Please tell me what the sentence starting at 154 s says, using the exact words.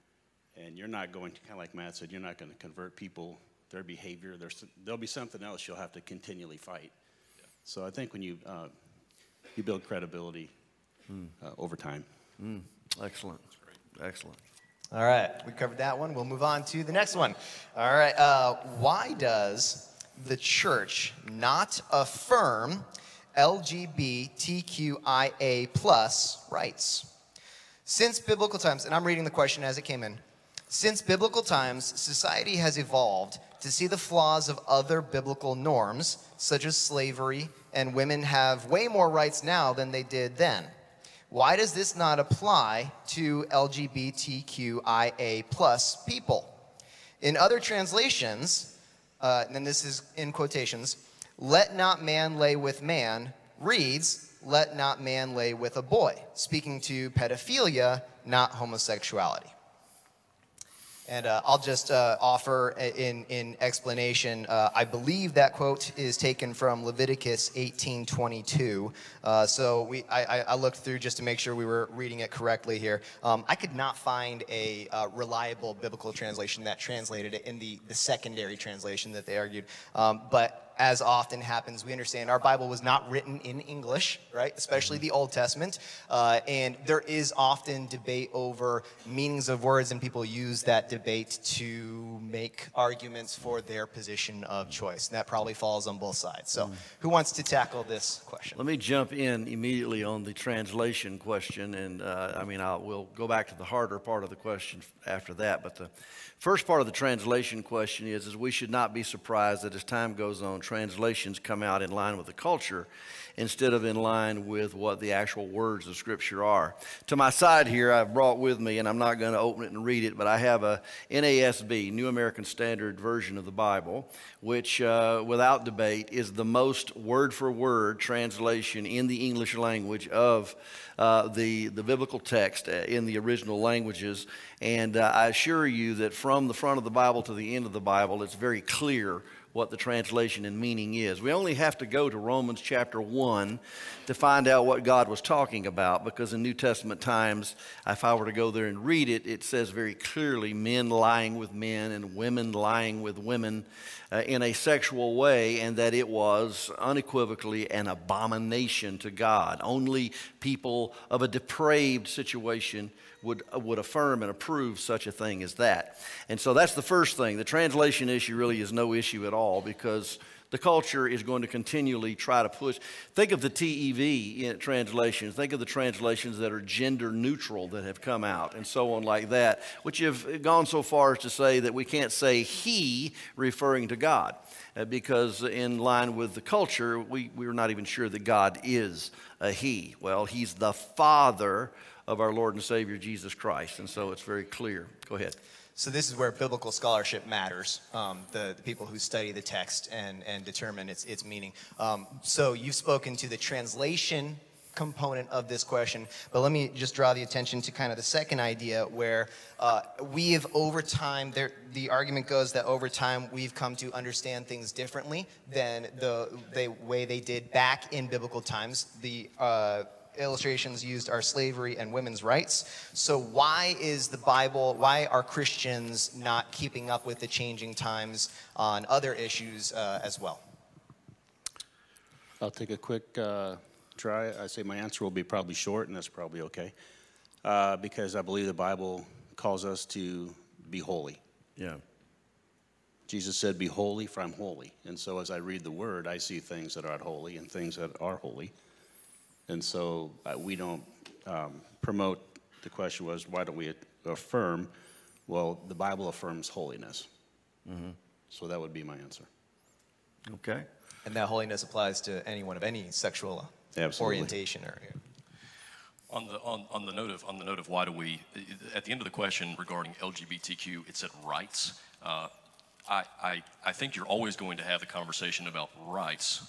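Uh, in a sexual way and that it was unequivocally an abomination to God.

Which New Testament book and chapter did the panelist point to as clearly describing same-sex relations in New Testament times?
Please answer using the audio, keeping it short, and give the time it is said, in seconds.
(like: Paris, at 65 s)
Romans chapter 1, at 142 s.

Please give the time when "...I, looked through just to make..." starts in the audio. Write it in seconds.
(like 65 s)
70 s.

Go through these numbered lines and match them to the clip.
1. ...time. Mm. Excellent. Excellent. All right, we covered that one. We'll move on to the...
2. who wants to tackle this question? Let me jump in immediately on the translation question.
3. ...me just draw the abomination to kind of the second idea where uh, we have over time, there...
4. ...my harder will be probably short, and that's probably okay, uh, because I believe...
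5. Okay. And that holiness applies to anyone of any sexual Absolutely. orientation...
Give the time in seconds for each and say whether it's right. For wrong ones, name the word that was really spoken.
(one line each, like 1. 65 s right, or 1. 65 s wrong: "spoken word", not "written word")
1. 11 s right
2. 96 s right
3. 206 s wrong: "attention", not "abomination"
4. 234 s wrong: "answer", not "harder"
5. 260 s right.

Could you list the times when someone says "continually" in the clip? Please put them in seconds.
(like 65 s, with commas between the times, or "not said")
6 s, 171 s.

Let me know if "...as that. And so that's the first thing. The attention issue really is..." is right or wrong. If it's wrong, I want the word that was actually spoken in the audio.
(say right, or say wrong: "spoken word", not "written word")
wrong: "translation", not "attention".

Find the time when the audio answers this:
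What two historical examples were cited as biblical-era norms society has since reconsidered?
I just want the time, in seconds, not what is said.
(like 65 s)
221 s.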